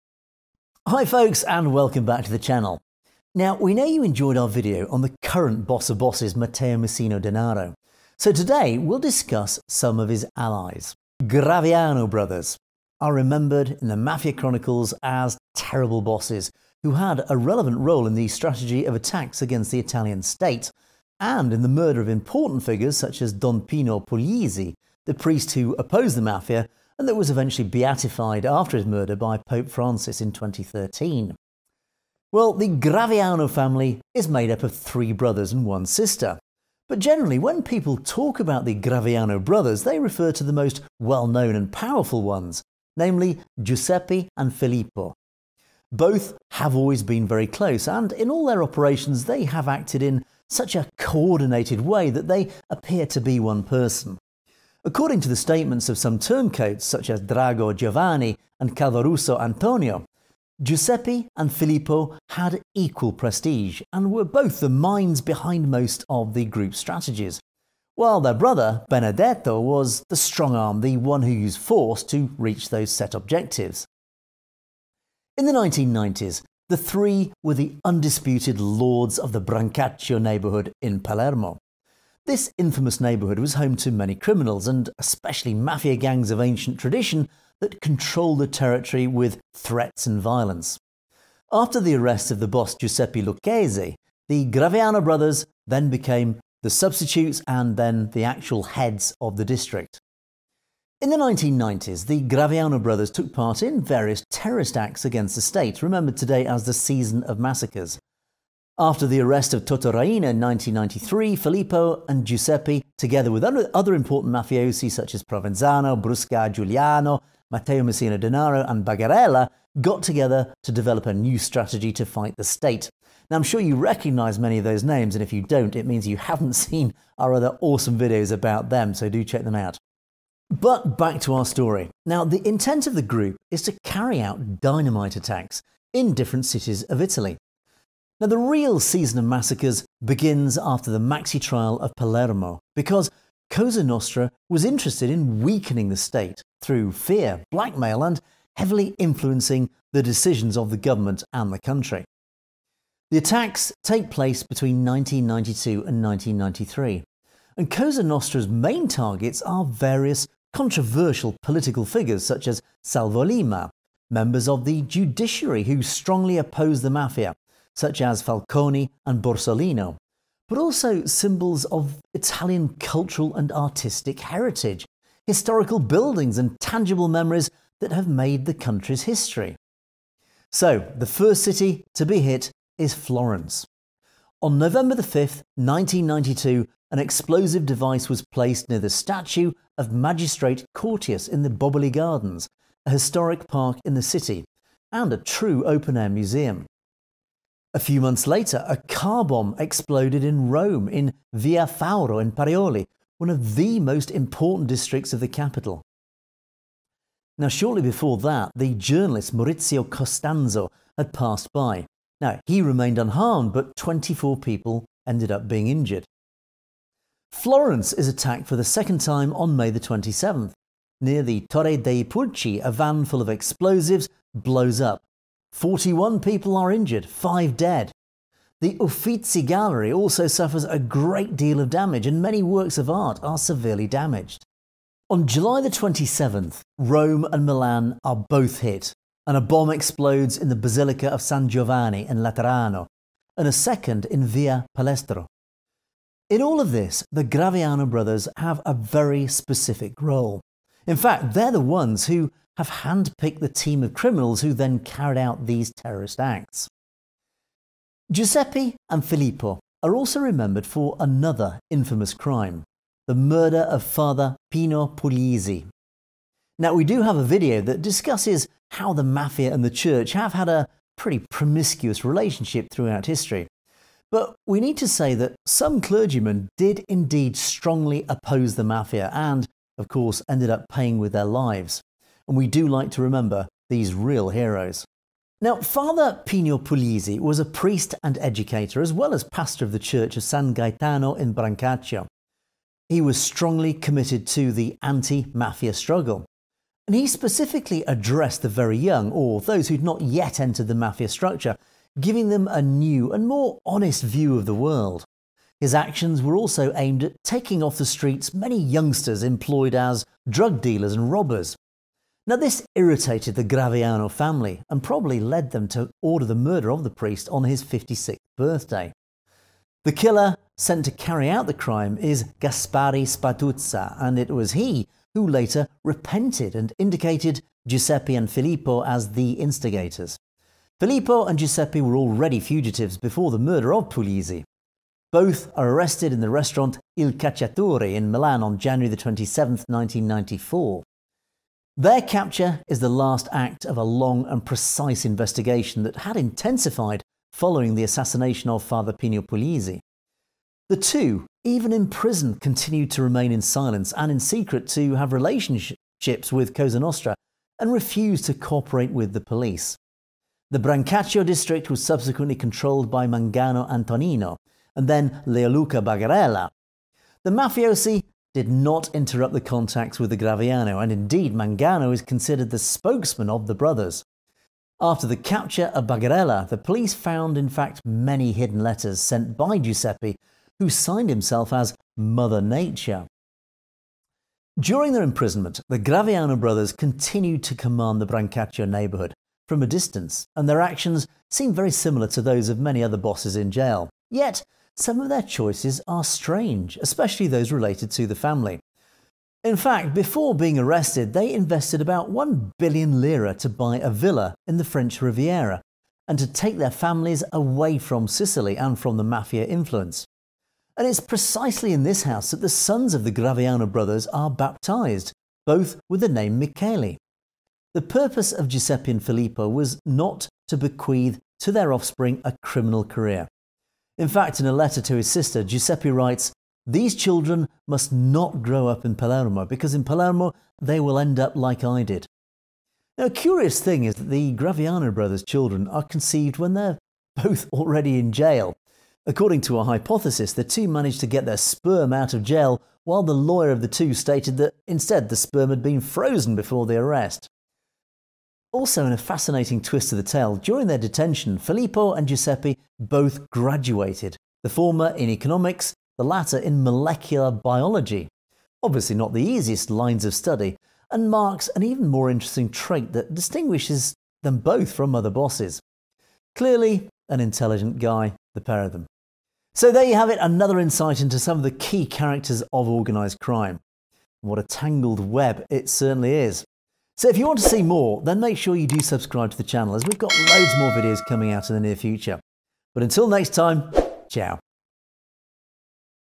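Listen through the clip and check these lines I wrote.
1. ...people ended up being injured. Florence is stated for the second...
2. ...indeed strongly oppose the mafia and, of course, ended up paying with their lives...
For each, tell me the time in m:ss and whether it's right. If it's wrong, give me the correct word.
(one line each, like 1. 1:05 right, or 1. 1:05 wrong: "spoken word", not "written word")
1. 3:34 wrong: "attacked", not "stated"
2. 4:36 right.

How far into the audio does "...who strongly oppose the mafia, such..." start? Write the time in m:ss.
2:45.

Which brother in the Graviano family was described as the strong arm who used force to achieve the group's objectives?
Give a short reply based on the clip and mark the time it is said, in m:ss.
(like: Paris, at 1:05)
Benedetto, at 1:08.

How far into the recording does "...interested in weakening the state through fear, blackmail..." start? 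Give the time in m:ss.
2:24.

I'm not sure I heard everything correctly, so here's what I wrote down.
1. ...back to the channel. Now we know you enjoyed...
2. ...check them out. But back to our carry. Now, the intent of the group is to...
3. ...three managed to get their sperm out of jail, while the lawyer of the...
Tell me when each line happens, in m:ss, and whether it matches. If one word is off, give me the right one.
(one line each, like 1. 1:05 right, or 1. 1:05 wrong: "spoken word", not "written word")
1. 0:02 right
2. 2:09 wrong: "story", not "carry"
3. 7:20 wrong: "two", not "three".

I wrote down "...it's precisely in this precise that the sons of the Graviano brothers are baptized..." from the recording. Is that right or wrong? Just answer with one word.
wrong.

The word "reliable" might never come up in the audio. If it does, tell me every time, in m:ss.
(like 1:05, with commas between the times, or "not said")
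not said.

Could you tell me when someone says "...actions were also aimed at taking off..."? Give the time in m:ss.
5:05.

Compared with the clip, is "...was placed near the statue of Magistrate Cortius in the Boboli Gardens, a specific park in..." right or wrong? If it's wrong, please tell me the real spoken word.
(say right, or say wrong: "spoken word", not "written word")
wrong: "historic", not "specific".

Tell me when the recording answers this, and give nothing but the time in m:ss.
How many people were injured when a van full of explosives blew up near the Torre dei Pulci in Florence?
3:45.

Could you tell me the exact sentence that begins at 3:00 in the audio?
So, the first city to be hit is Florence.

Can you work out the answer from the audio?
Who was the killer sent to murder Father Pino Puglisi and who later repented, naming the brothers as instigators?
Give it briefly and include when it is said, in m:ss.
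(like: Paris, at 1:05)
Gaspare Spatuzza, at 5:22.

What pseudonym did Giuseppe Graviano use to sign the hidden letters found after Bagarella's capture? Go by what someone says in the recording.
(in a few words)
Mother Nature.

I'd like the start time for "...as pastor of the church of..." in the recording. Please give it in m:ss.
4:49.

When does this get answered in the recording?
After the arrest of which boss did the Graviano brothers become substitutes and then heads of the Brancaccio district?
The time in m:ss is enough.
1:32.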